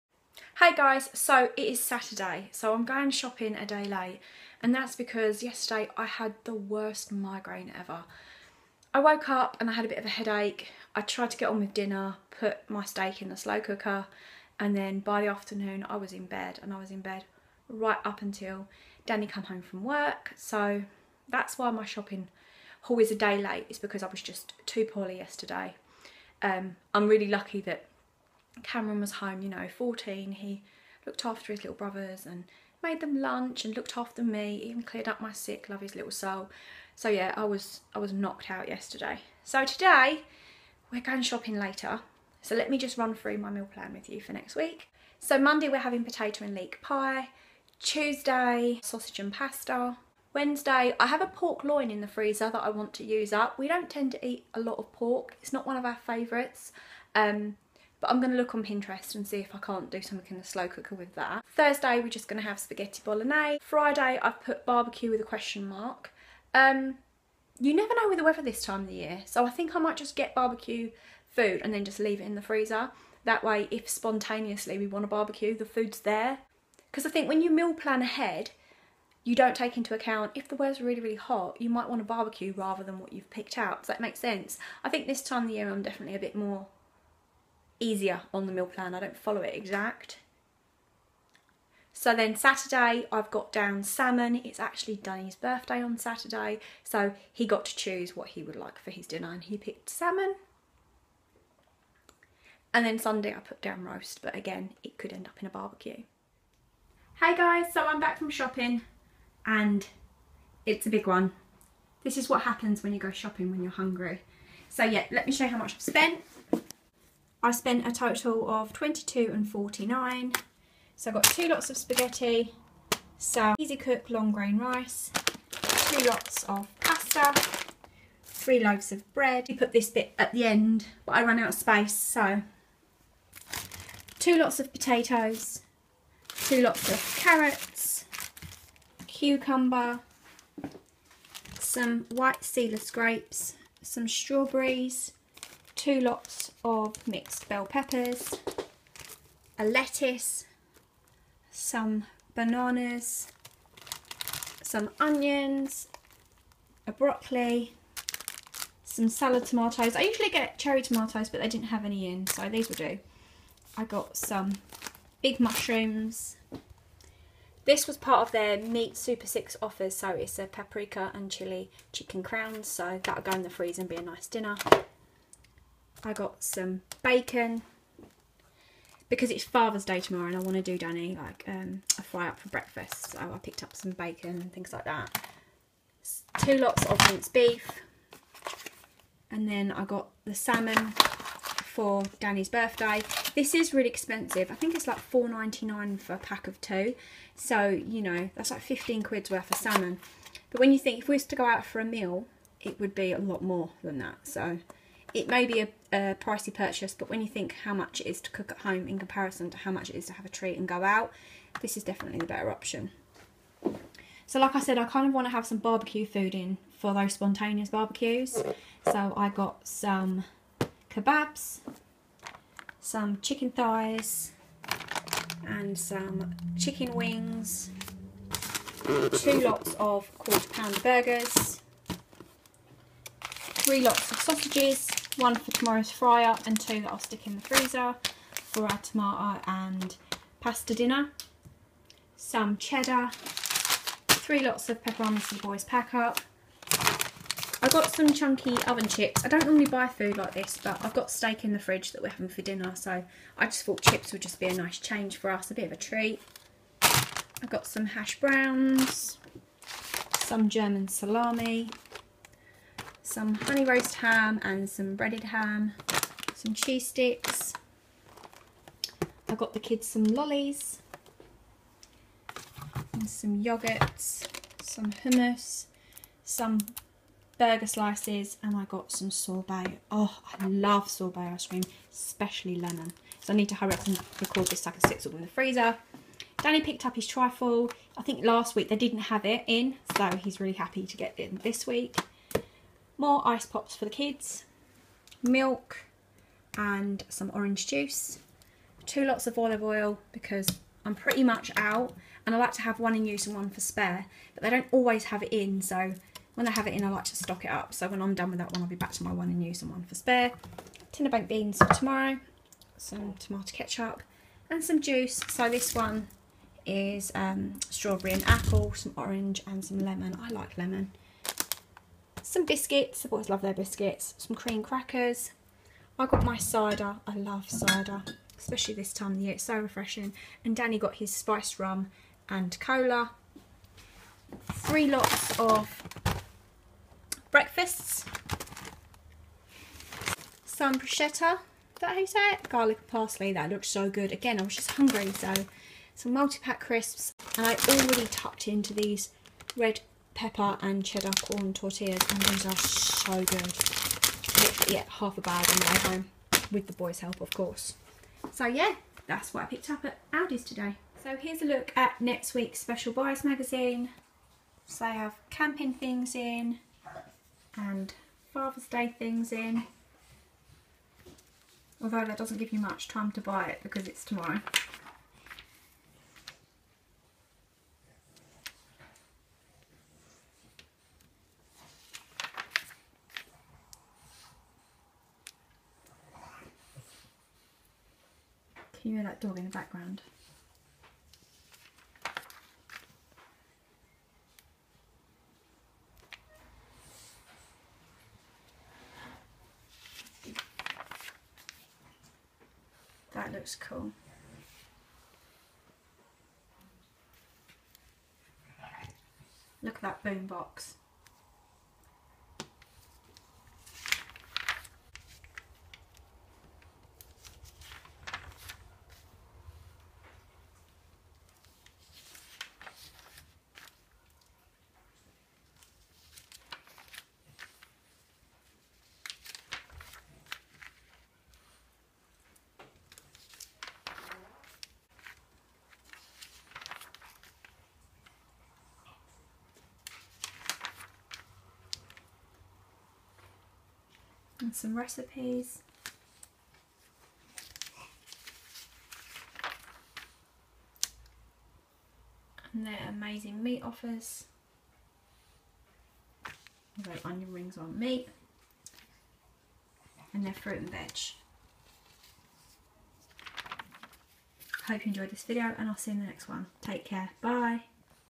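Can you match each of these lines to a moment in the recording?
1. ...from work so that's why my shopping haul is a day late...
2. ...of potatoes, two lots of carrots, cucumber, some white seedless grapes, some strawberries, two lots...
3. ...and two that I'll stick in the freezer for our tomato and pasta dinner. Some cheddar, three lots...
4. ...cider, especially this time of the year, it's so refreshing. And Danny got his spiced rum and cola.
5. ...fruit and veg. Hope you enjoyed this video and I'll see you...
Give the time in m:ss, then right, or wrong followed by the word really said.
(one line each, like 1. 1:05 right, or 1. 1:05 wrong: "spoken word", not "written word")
1. 0:19 right
2. 2:14 right
3. 3:56 right
4. 5:27 right
5. 7:40 right.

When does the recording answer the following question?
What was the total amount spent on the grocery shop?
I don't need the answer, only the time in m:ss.
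1:58.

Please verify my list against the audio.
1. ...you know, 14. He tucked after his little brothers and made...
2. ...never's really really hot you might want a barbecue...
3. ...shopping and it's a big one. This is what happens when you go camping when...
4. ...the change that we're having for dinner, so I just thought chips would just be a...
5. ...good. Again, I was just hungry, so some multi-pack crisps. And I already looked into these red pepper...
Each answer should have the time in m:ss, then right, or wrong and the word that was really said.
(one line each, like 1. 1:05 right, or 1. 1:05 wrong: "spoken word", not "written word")
1. 0:29 wrong: "looked", not "tucked"
2. 1:20 wrong: "weather", not "never"
3. 1:48 wrong: "shopping", not "camping"
4. 4:11 wrong: "fridge", not "change"
5. 5:43 wrong: "tucked", not "looked".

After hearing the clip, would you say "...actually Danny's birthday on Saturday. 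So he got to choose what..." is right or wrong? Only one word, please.
right.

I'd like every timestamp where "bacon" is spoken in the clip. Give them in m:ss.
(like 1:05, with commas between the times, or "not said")
2:57, 3:03.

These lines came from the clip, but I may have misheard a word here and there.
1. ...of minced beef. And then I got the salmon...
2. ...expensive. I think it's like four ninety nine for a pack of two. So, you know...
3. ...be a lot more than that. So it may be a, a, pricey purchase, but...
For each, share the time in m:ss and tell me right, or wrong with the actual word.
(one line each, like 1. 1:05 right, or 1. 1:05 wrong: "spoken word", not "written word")
1. 3:06 right
2. 3:13 right
3. 3:22 right.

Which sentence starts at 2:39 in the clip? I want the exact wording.
I usually get cherry tomatoes, but they didn't have any in, so these will do.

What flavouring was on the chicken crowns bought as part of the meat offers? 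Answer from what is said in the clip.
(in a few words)
Paprika and chili.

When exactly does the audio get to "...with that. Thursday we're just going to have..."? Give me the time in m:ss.
1:00.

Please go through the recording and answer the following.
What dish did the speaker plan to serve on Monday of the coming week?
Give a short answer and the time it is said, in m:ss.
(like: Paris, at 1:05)
Potato and leek pie, at 0:46.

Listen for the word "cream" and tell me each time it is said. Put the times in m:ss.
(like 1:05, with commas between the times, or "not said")
4:41, 5:24.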